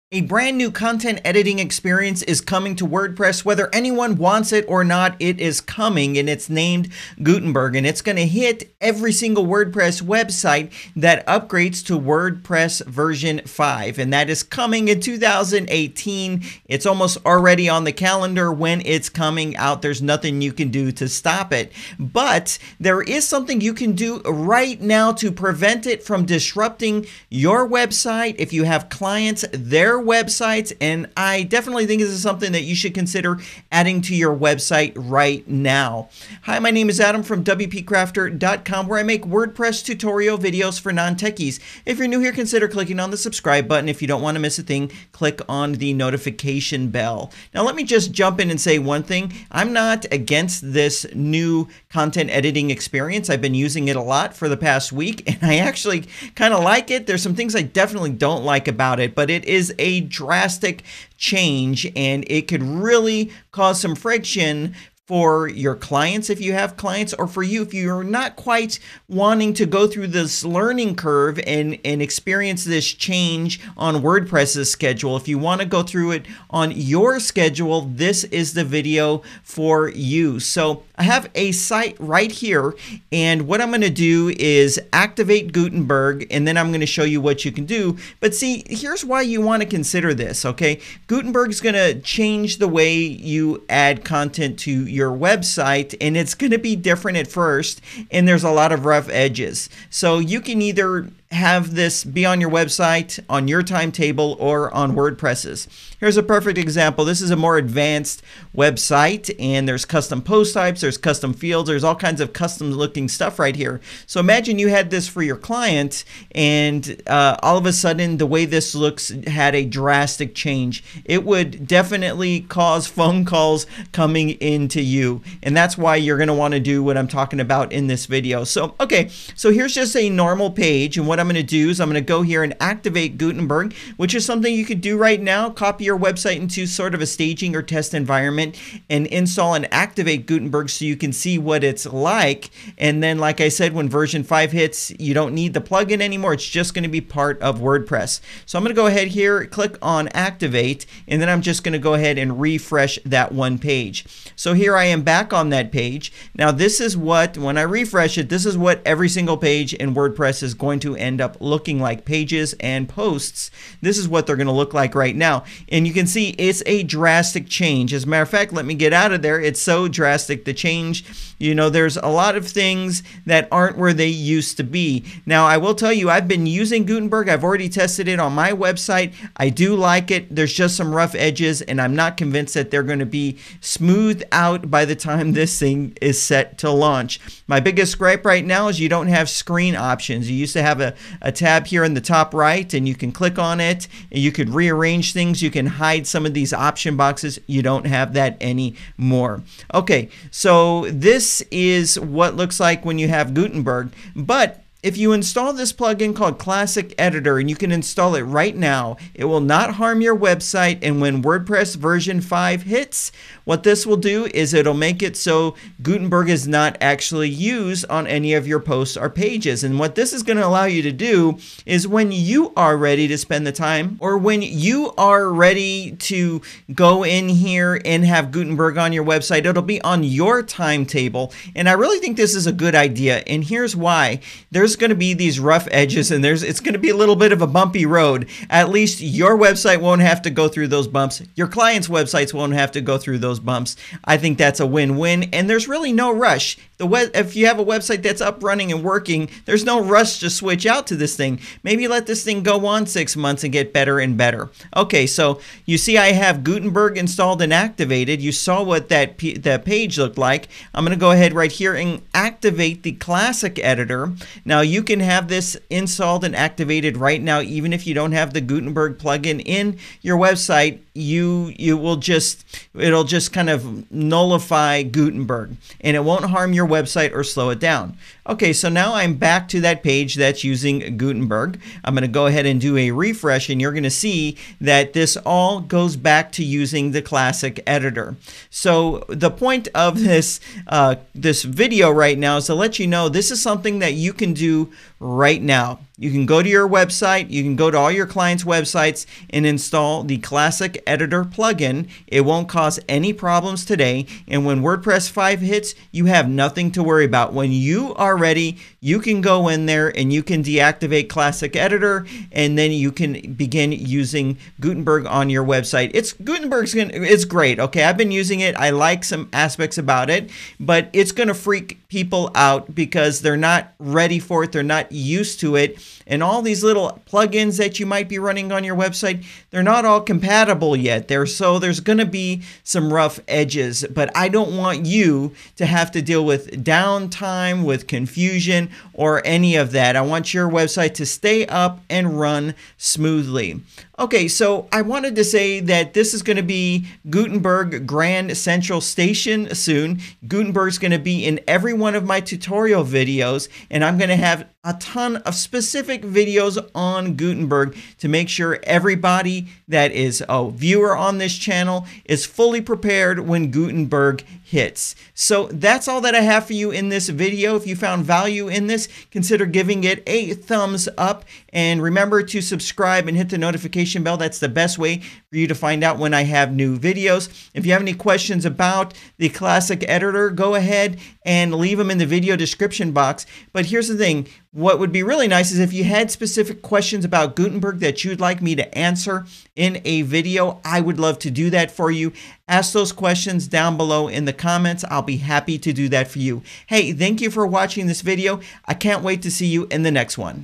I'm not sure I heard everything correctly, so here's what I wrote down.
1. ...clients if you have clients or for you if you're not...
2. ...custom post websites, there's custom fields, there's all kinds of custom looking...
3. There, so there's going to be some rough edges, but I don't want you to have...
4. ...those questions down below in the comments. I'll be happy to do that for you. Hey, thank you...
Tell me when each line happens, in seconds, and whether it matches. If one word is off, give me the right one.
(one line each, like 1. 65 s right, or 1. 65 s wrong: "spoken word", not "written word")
1. 65 s right
2. 109 s wrong: "types", not "websites"
3. 331 s right
4. 392 s right.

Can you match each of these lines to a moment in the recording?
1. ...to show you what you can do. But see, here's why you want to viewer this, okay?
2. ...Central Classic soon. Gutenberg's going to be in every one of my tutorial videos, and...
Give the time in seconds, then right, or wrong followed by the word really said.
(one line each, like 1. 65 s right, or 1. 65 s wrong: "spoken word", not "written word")
1. 86 s wrong: "consider", not "viewer"
2. 348 s wrong: "Station", not "Classic".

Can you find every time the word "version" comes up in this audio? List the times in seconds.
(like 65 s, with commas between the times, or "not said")
12 s, 143 s, 211 s.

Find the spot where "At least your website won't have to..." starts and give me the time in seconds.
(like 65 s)
238 s.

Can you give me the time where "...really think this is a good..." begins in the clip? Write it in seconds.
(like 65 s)
231 s.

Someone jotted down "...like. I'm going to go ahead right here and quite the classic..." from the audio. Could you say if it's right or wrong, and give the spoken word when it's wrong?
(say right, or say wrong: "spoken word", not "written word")
wrong: "activate", not "quite".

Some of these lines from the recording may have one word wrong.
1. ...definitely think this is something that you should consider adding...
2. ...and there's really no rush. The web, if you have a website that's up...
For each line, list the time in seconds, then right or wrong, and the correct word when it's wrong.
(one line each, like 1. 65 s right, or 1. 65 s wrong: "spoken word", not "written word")
1. 31 s right
2. 245 s right.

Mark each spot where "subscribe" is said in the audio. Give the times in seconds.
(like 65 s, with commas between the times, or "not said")
43 s, 372 s.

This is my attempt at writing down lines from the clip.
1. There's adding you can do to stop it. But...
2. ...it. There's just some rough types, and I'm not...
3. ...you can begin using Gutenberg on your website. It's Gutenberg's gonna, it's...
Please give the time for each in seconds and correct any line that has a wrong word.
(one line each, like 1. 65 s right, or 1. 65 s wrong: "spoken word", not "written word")
1. 19 s wrong: "nothing", not "adding"
2. 180 s wrong: "edges", not "types"
3. 312 s right.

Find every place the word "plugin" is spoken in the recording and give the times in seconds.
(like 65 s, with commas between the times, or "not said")
145 s, 205 s, 268 s, 301 s, 327 s.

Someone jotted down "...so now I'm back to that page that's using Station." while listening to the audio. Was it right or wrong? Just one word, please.
wrong.